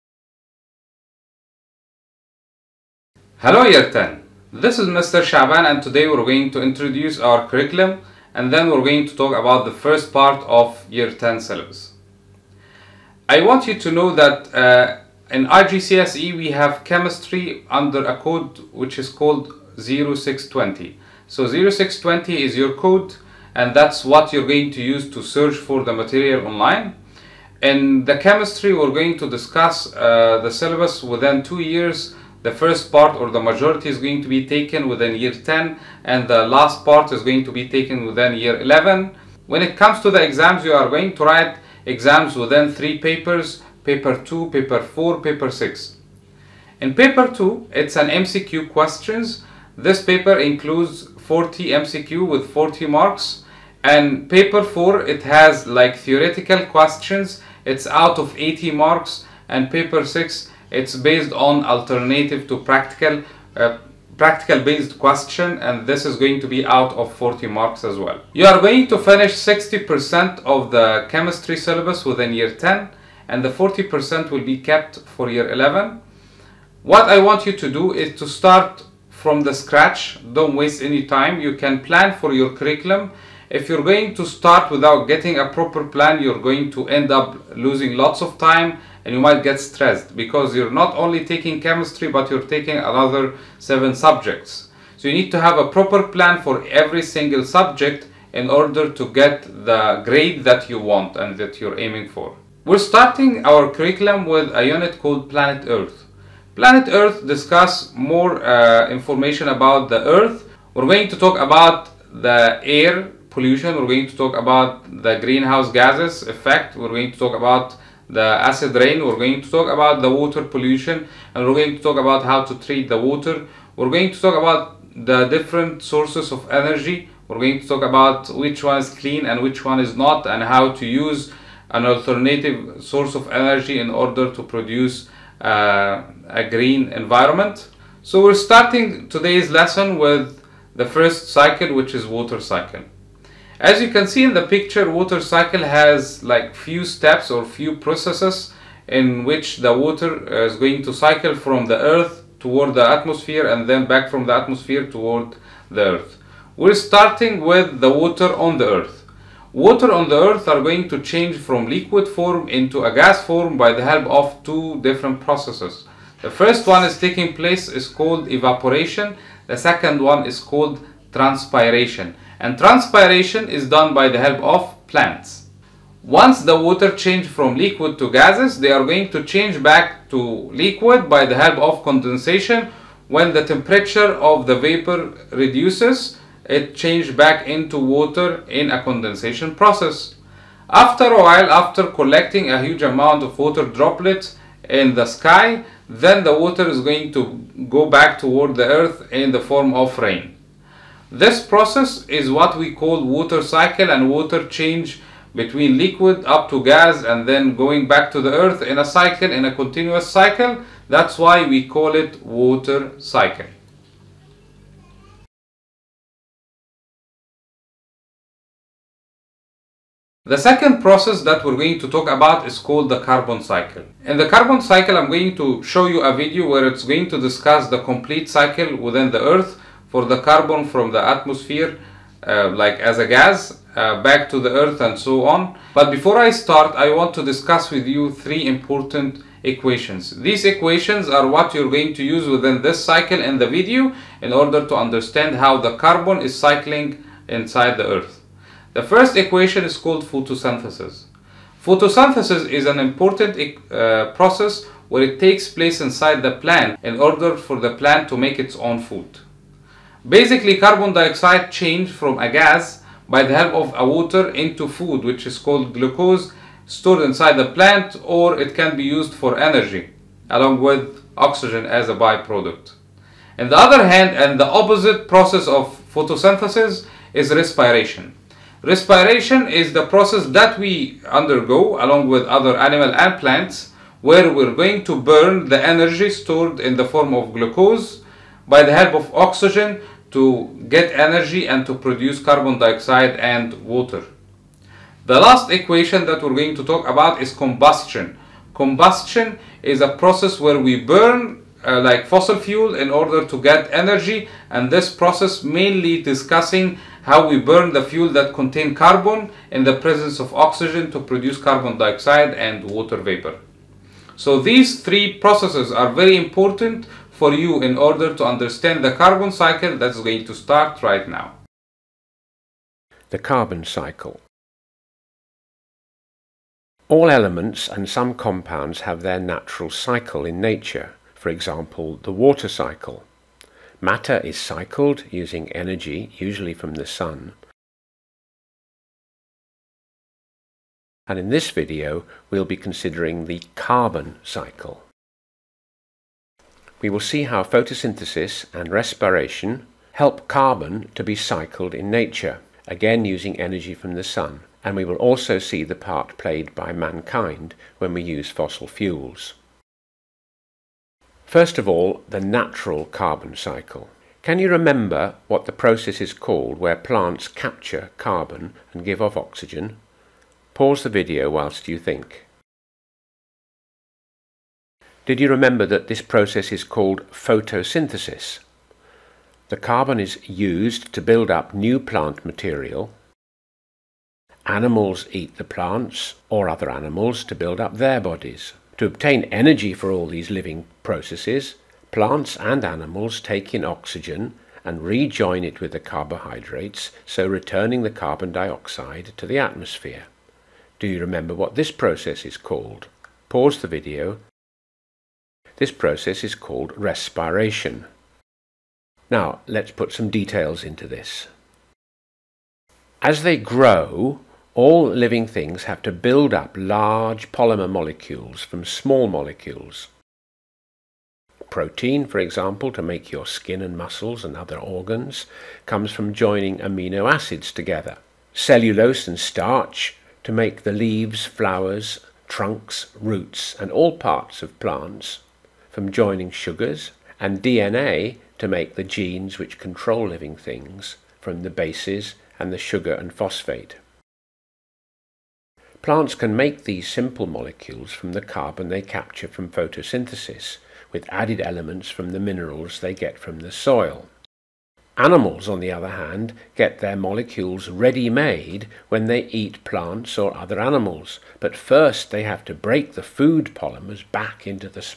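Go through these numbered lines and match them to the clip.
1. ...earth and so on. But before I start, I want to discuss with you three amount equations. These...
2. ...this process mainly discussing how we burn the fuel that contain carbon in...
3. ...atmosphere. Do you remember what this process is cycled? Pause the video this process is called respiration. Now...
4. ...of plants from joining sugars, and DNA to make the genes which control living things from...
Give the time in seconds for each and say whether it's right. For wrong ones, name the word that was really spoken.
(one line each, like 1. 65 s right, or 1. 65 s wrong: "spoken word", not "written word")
1. 234 s wrong: "important", not "amount"
2. 304 s right
3. 399 s wrong: "called", not "cycled"
4. 434 s right.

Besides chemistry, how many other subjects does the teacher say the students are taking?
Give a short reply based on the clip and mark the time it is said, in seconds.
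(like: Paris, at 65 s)
7, at 93 s.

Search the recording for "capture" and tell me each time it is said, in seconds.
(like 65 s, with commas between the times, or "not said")
367 s, 448 s.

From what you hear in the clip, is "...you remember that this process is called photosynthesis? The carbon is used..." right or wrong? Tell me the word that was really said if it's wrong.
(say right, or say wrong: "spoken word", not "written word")
right.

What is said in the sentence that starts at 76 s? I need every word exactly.
What I want you to do is to start from the scratch.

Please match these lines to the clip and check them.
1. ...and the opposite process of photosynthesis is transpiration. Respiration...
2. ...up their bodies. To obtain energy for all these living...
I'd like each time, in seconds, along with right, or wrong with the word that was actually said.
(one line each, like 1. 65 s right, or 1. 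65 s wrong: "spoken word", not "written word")
1. 274 s wrong: "respiration", not "transpiration"
2. 387 s right.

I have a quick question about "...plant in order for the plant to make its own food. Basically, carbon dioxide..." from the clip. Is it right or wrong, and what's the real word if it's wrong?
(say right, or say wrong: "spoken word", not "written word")
right.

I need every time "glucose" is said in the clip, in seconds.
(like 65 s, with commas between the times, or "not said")
265 s, 287 s.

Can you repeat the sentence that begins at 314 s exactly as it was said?
So these three processes are very important for you in order to understand the carbon cycle that's going to start right now.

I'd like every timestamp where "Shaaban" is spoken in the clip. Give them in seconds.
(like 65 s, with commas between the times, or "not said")
5 s.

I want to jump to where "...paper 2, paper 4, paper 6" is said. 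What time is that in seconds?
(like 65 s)
43 s.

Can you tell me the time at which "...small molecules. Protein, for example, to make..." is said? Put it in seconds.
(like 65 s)
418 s.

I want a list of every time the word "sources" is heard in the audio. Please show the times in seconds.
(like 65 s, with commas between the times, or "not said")
125 s, 132 s.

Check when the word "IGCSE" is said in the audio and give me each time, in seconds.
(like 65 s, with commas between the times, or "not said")
15 s.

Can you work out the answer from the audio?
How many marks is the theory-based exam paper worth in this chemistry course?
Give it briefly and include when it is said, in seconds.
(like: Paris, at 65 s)
80 marks, at 58 s.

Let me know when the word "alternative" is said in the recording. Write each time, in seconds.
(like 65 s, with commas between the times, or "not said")
61 s, 131 s.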